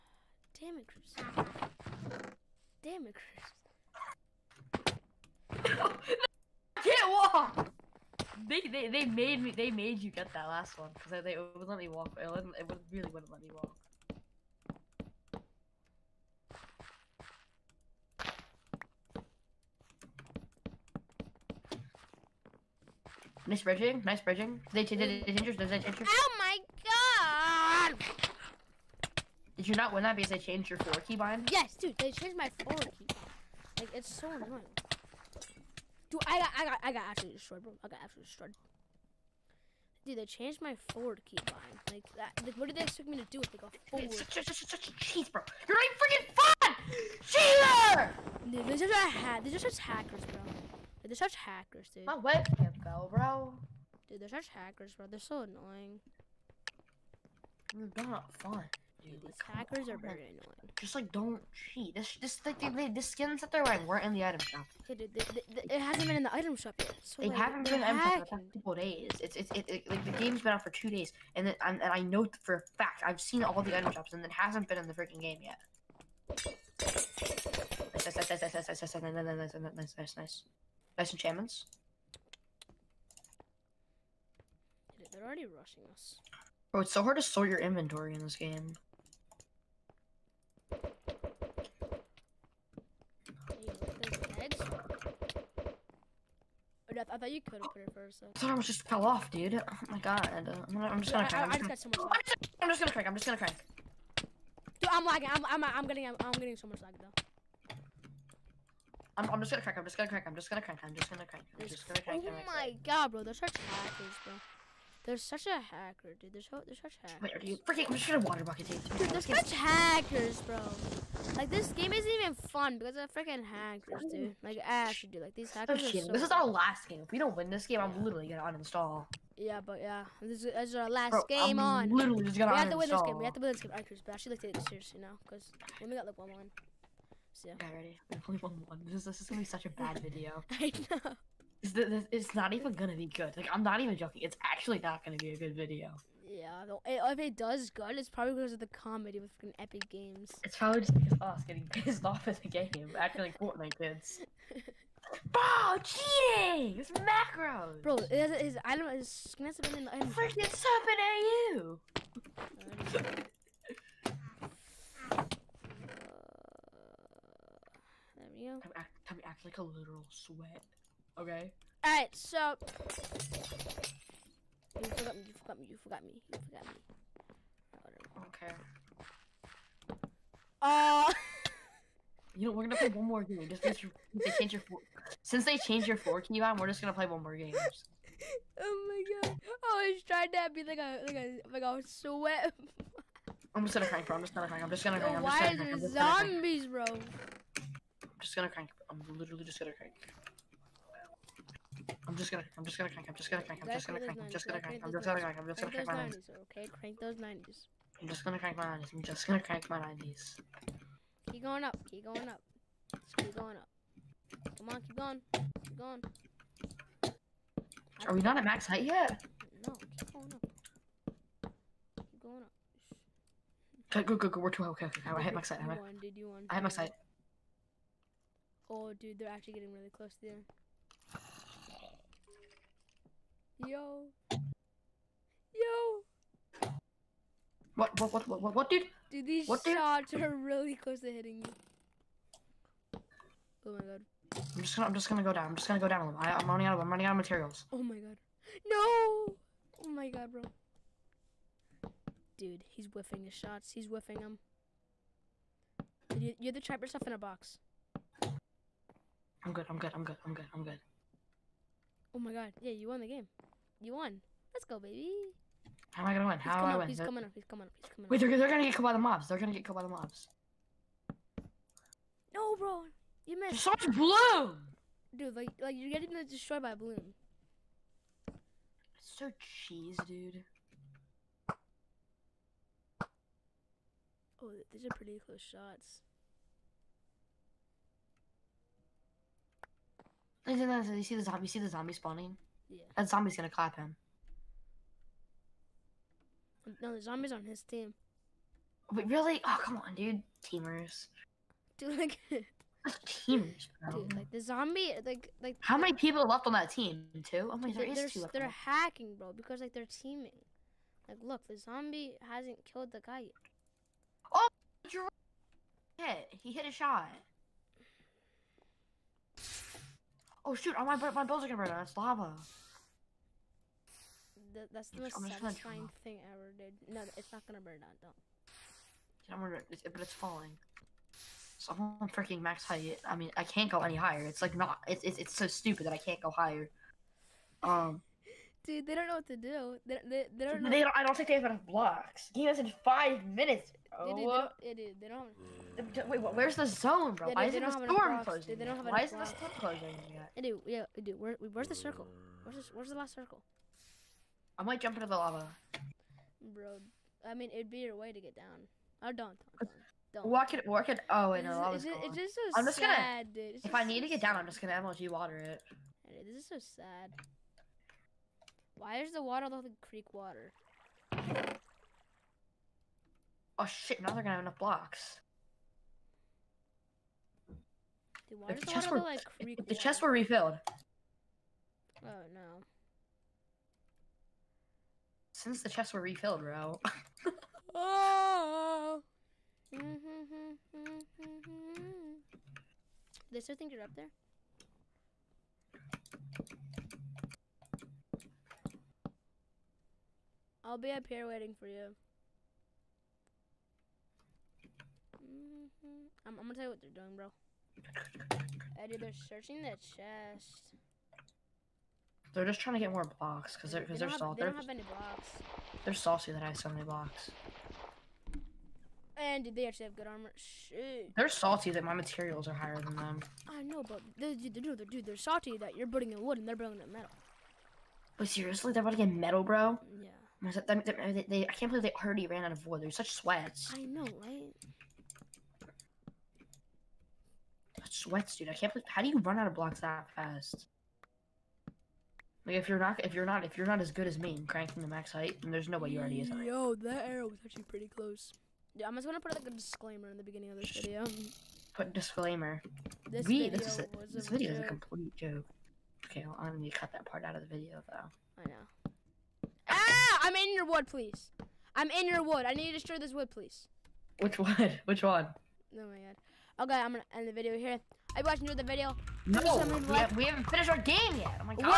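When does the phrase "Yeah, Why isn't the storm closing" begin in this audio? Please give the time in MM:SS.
05:47.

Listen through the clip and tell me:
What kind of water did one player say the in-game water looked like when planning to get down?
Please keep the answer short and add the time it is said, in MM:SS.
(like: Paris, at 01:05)
creek water, at 06:09.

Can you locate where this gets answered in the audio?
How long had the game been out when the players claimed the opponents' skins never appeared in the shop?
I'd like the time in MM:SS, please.
01:10.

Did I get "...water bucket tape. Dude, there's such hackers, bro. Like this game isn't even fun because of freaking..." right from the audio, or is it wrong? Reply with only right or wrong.
right.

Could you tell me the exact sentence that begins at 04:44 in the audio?
Oh, these are pretty close shots.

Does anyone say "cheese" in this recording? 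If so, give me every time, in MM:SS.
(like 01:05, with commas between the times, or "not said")
00:44, 04:39.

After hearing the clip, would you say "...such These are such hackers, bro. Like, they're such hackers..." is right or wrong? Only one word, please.
right.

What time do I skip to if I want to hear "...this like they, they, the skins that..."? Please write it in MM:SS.
01:02.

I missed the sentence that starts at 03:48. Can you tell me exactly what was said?
Oh, dude, they're actually getting really close there.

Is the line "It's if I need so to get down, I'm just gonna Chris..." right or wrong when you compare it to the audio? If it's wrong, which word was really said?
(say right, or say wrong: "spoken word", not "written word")
wrong: "MLG", not "Chris".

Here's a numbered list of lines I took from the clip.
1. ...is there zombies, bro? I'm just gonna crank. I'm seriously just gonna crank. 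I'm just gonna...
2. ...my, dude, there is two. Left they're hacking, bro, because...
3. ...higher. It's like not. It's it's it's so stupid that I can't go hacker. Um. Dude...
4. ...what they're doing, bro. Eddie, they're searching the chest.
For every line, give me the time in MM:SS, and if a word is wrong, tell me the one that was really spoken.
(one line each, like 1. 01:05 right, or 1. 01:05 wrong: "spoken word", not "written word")
1. 03:15 wrong: "literally", not "seriously"
2. 05:07 right
3. 05:33 wrong: "higher", not "hacker"
4. 06:46 right.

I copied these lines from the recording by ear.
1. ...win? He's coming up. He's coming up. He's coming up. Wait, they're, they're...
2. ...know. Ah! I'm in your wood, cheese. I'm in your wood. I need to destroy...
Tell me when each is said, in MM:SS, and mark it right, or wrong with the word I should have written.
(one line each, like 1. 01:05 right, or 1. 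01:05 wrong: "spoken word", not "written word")
1. 04:26 right
2. 07:38 wrong: "please", not "cheese".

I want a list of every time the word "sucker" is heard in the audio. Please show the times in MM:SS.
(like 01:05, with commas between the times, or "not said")
not said.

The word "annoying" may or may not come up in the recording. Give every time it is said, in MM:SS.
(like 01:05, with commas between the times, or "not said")
00:34, 00:55, 01:00.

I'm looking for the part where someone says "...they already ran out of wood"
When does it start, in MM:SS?
07:11.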